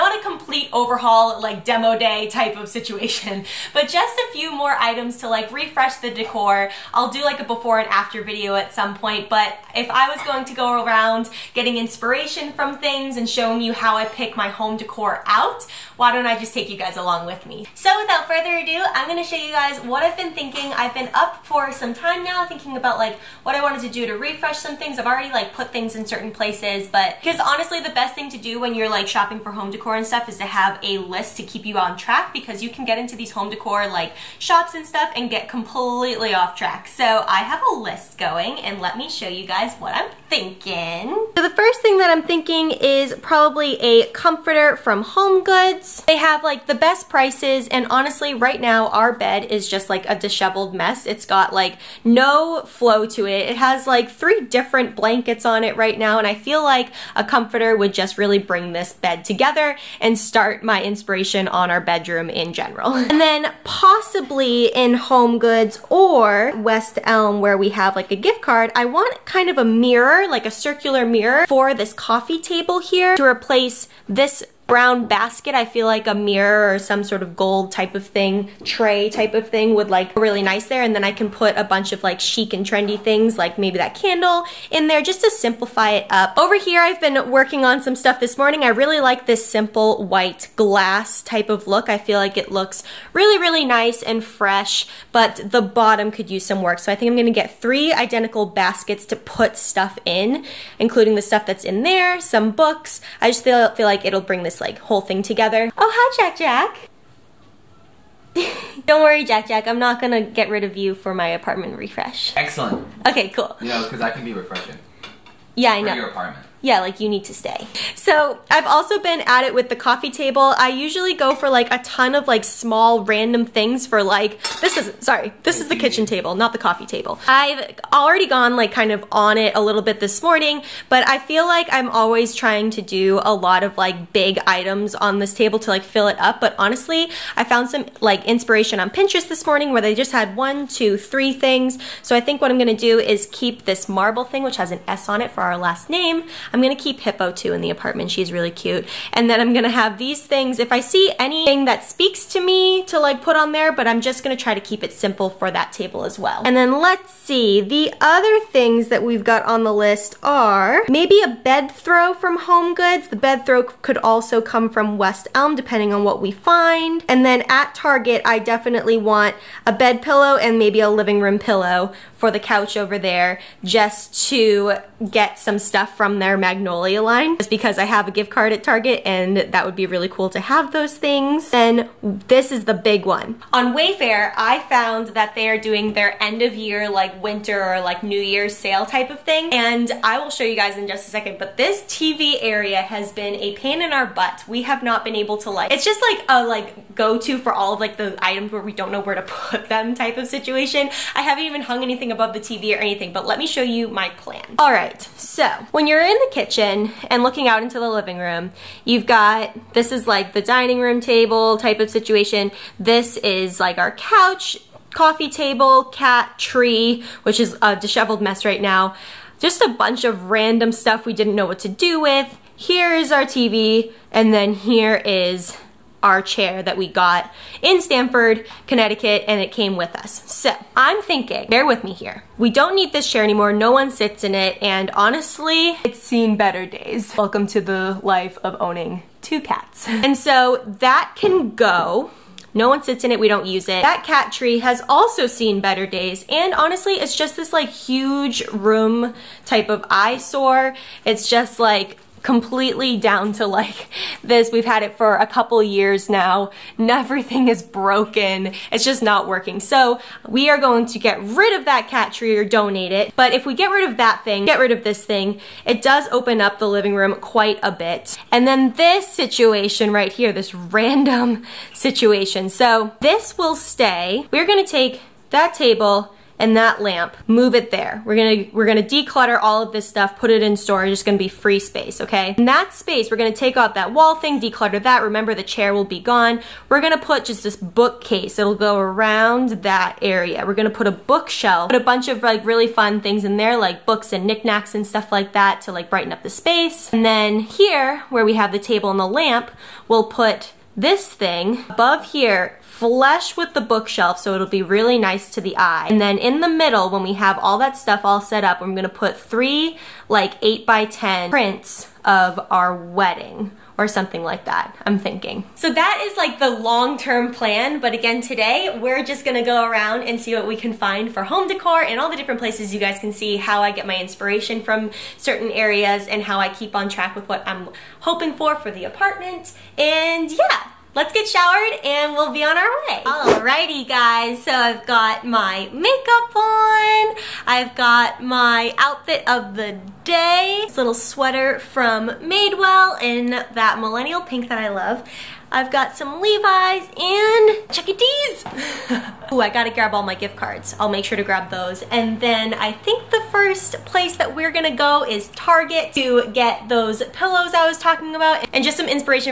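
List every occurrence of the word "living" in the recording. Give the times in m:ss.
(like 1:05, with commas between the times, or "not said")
2:50, 3:27, 4:26.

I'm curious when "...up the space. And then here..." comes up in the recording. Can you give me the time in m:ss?
4:56.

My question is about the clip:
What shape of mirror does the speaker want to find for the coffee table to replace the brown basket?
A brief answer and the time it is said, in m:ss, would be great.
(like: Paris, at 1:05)
Circular, at 1:10.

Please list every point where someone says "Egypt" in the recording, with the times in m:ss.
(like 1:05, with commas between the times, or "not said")
not said.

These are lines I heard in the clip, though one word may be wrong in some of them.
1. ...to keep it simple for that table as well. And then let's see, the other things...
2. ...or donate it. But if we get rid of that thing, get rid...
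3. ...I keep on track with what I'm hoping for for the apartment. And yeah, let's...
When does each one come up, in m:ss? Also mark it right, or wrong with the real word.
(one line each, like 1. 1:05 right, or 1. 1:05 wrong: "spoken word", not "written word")
1. 2:34 right
2. 4:22 right
3. 5:26 right.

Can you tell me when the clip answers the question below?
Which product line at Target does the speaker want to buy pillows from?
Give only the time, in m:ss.
2:56.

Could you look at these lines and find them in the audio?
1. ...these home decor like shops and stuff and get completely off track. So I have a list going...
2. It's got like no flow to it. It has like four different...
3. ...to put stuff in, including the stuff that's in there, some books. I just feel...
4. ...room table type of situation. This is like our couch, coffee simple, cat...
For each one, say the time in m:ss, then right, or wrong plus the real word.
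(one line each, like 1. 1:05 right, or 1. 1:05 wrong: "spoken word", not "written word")
1. 0:33 right
2. 0:51 wrong: "three", not "four"
3. 1:39 right
4. 3:30 wrong: "table", not "simple".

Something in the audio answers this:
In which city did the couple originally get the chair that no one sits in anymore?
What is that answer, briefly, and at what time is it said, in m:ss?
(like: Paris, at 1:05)
Stamford, Connecticut, at 3:47.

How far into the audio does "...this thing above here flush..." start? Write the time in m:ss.
5:00.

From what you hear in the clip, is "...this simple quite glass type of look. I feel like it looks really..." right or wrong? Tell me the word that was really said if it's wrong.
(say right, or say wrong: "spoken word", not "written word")
wrong: "white", not "quite".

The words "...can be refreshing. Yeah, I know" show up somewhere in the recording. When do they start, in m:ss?
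1:54.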